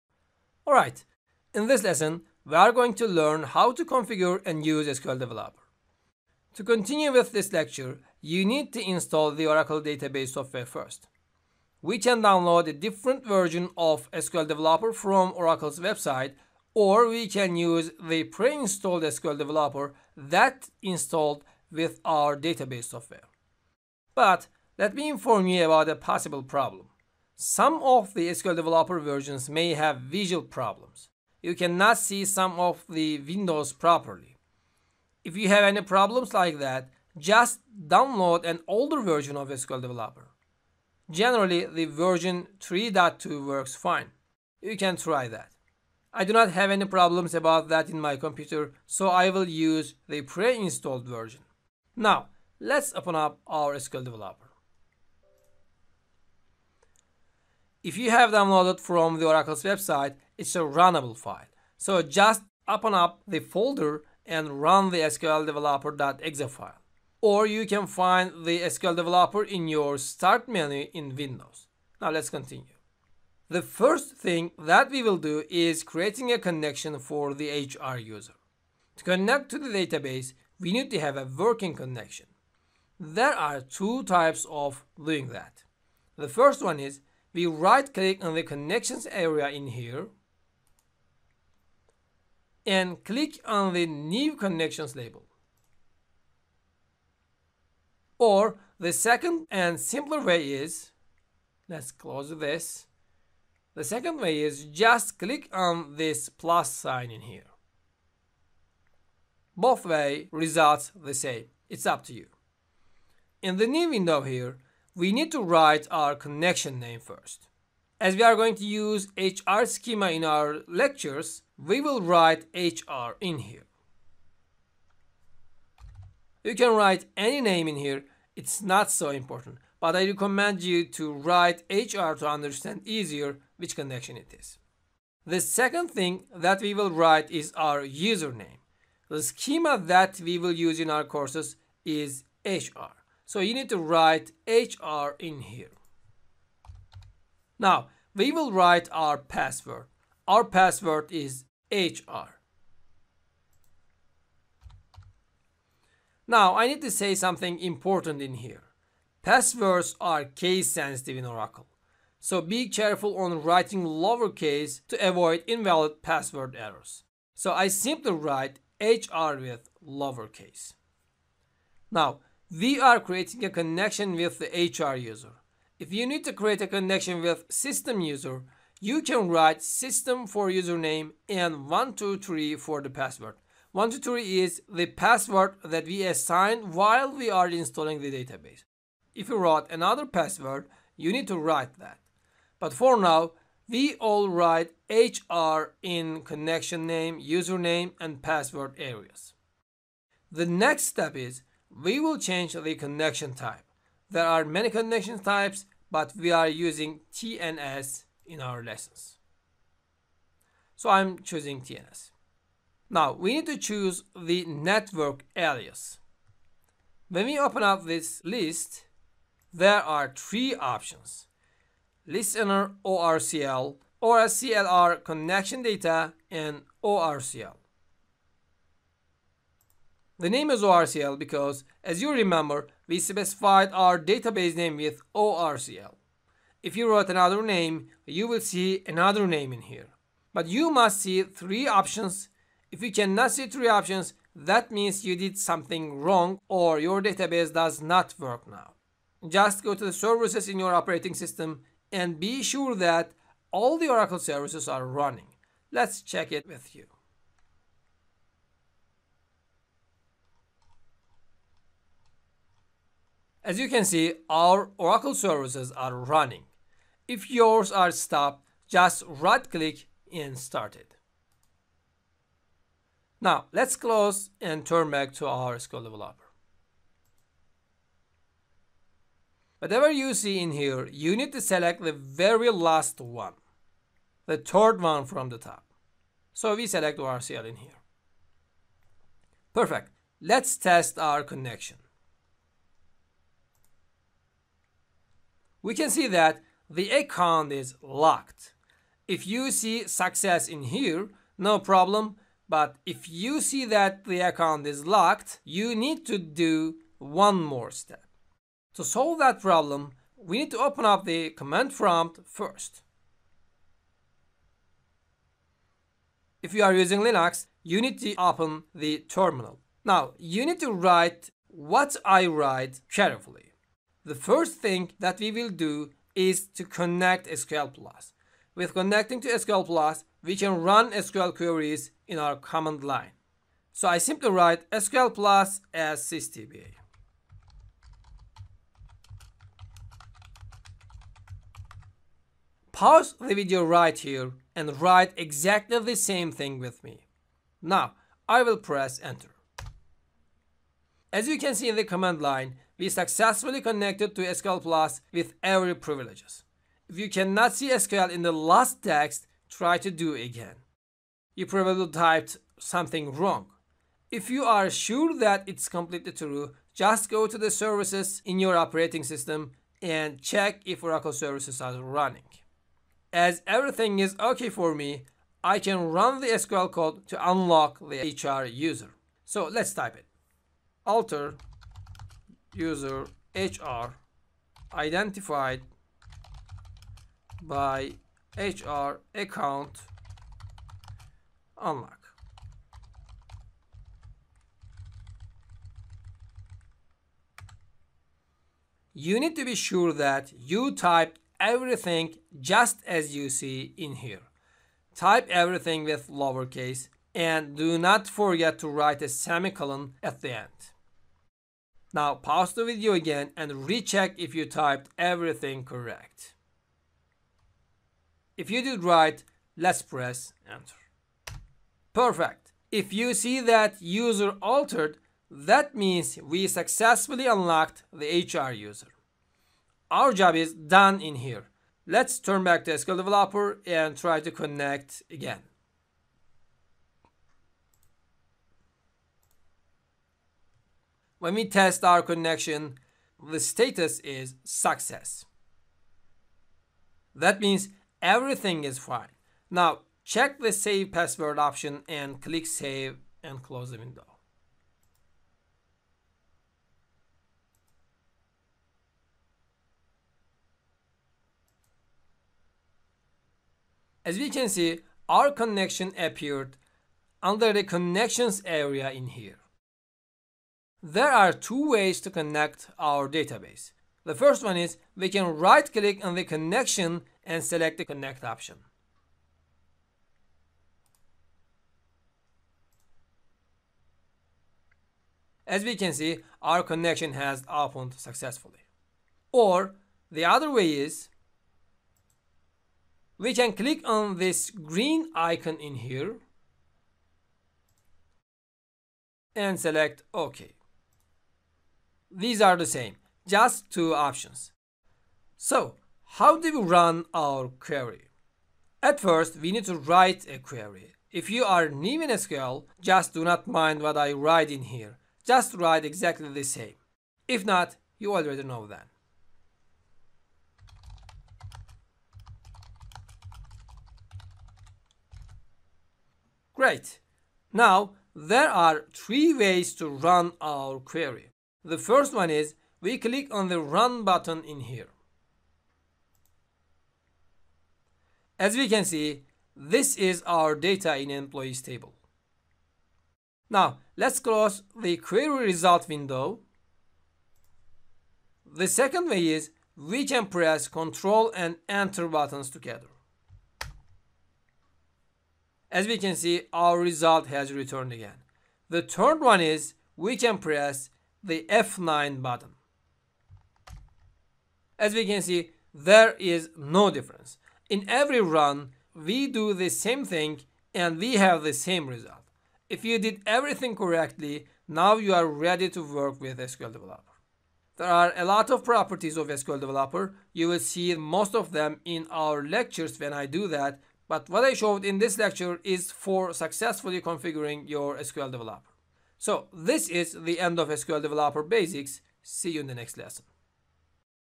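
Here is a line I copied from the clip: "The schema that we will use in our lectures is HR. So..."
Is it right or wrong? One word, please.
wrong.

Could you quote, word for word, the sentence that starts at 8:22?
These are the same, just two options.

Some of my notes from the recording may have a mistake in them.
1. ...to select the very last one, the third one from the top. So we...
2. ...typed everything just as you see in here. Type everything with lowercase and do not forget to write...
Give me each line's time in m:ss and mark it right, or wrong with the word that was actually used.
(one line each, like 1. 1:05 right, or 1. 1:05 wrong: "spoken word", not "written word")
1. 4:41 right
2. 6:40 right.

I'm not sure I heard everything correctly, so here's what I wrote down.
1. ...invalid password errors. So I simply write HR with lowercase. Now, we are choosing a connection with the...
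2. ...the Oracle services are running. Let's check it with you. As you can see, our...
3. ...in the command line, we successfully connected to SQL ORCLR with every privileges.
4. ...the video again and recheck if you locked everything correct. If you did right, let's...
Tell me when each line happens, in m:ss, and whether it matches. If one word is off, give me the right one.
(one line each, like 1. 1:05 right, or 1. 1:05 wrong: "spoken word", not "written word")
1. 2:45 wrong: "creating", not "choosing"
2. 4:13 right
3. 5:51 wrong: "Plus", not "ORCLR"
4. 6:52 wrong: "typed", not "locked".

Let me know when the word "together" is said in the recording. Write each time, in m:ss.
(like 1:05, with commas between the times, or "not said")
9:12.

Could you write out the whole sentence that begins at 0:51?
Now, let's open up our SQL Developer.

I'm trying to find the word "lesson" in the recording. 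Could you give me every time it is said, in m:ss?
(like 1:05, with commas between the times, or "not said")
0:01, 3:28, 9:52.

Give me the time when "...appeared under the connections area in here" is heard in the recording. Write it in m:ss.
7:45.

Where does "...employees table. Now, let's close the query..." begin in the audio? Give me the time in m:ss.
9:01.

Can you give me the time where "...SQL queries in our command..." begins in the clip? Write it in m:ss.
5:30.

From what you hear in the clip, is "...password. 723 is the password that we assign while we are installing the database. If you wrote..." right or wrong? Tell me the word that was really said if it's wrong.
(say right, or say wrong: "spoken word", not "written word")
wrong: "123", not "723".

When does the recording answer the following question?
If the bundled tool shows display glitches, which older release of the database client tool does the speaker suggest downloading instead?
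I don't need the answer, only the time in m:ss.
0:42.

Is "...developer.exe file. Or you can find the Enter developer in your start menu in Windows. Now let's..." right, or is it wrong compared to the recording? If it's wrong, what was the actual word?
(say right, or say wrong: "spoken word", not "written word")
wrong: "SQL", not "Enter".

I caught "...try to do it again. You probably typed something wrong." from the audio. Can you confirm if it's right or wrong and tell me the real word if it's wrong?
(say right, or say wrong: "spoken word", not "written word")
right.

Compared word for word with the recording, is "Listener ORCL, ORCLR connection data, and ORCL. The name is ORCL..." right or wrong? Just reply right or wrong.
right.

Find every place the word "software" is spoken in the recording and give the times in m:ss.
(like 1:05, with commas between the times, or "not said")
0:10, 0:22.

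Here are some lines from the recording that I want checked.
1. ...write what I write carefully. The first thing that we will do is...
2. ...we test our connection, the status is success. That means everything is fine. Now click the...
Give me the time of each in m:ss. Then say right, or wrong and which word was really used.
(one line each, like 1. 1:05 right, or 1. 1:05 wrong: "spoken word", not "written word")
1. 5:20 right
2. 7:21 wrong: "check", not "click".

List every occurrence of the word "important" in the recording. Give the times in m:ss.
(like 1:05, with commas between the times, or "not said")
2:09, 2:37.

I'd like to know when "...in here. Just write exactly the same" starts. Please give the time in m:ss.
8:34.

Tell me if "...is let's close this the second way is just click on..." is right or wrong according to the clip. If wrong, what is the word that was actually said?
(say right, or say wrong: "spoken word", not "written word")
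right.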